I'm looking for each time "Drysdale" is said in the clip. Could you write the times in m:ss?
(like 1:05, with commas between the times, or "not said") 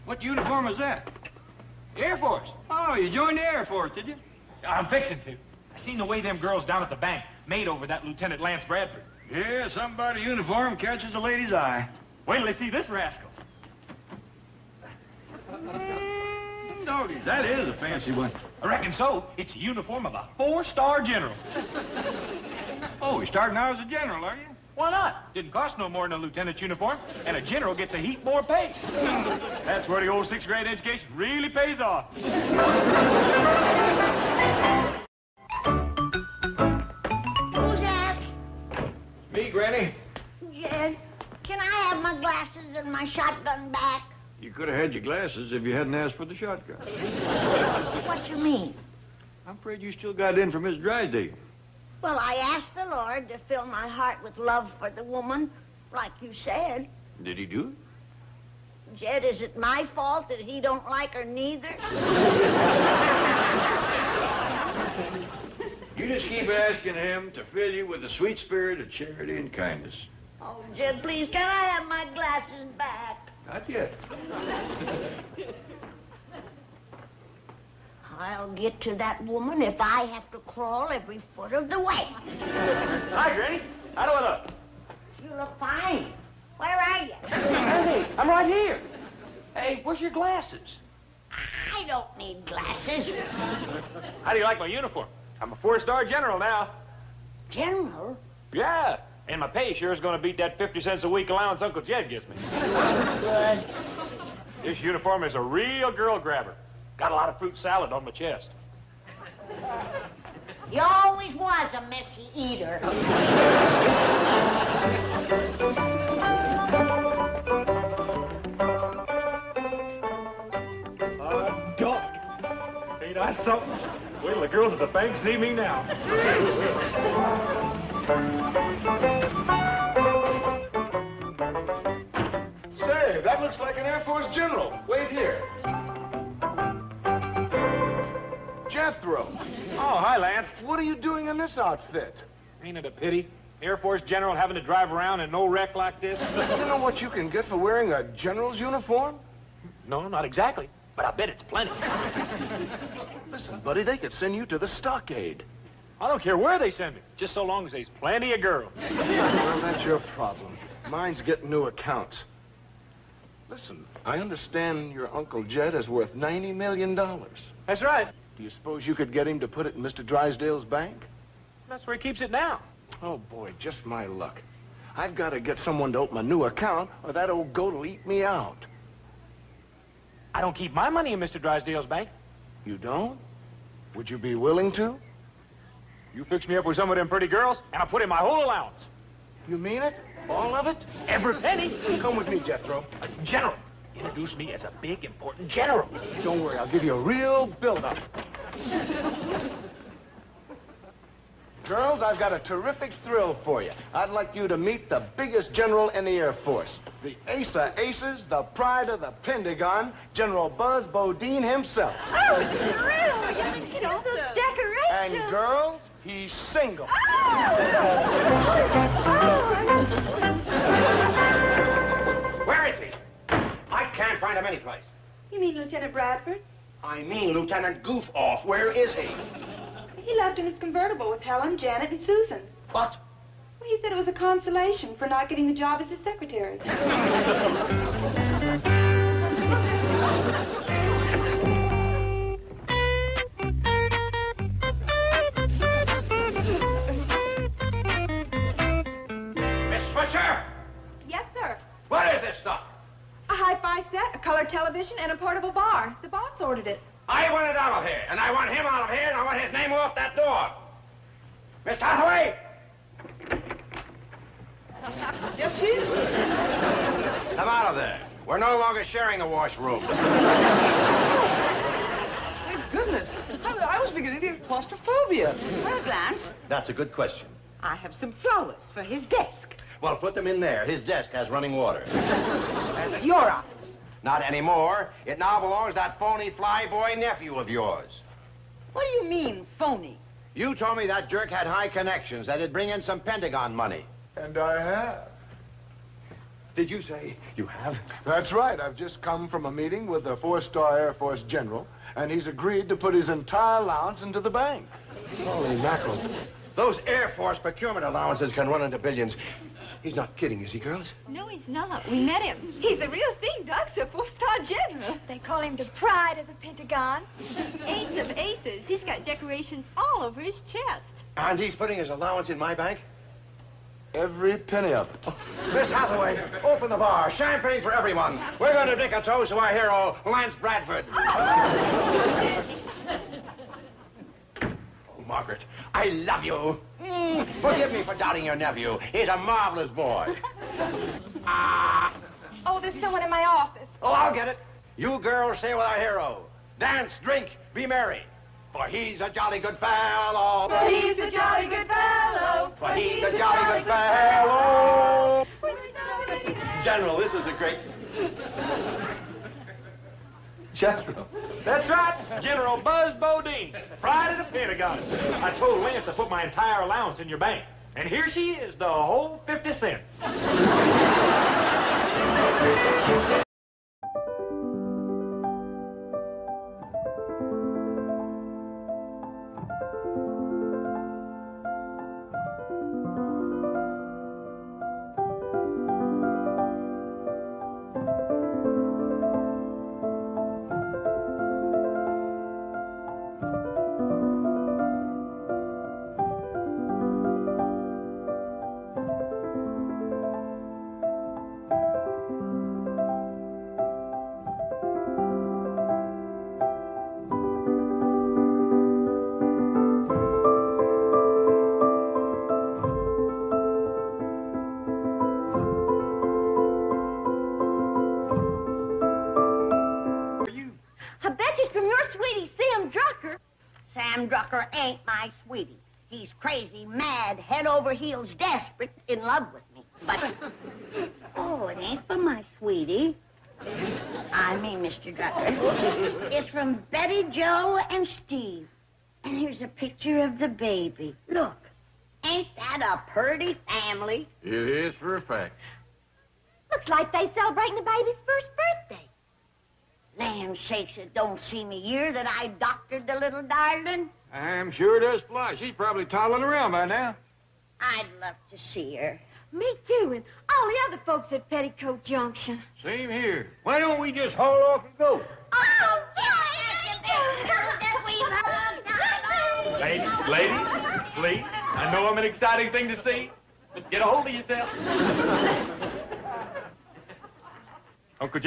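0:50, 2:50, 3:01.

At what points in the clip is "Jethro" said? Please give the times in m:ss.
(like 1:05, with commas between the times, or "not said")
2:18, 3:12, 6:00.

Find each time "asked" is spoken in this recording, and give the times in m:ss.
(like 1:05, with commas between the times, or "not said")
0:45, 0:52.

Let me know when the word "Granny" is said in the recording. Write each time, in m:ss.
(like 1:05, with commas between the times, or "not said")
0:39, 1:23.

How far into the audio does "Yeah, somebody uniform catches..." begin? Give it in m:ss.
0:09.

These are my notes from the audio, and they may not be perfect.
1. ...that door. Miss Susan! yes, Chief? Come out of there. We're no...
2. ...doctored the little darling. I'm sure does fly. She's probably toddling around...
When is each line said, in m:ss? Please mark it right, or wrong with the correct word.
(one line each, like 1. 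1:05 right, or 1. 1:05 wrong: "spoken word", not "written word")
1. 4:19 wrong: "Hathaway", not "Susan"
2. 7:32 right.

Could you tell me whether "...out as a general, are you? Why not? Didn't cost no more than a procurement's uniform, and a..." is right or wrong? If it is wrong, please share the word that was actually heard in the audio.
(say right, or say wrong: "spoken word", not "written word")
wrong: "lieutenant", not "procurement".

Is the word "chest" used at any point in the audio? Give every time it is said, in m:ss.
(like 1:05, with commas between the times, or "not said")
1:48, 5:20.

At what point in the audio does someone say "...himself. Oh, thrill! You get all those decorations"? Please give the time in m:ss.
3:31.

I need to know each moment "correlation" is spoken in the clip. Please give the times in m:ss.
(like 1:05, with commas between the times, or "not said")
not said.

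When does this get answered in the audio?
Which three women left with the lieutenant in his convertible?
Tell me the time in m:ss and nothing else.
3:51.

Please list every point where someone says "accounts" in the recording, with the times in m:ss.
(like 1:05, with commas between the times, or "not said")
2:41, 2:56.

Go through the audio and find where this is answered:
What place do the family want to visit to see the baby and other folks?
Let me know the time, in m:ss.
7:41.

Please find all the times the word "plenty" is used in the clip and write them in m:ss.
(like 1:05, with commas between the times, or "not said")
2:31, 2:37.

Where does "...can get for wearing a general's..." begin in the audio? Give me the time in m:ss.
2:27.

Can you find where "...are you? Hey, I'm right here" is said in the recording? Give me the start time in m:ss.
1:26.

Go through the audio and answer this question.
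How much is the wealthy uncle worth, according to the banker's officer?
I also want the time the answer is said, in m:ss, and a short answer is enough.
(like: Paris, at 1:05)
$90 million, at 2:46.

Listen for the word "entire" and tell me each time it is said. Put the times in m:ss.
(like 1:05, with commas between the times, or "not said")
5:03, 6:06.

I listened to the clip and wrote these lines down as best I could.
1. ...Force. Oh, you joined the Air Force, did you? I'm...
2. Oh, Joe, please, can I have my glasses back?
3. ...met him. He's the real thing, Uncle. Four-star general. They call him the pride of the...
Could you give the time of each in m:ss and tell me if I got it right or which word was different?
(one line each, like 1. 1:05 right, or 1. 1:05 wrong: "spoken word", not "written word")
1. 0:02 right
2. 1:10 wrong: "Jed", not "Joe"
3. 5:12 wrong: "Doctor", not "Uncle".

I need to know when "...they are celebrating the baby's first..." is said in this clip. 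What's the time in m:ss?
7:26.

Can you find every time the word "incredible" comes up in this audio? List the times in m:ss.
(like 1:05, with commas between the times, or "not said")
not said.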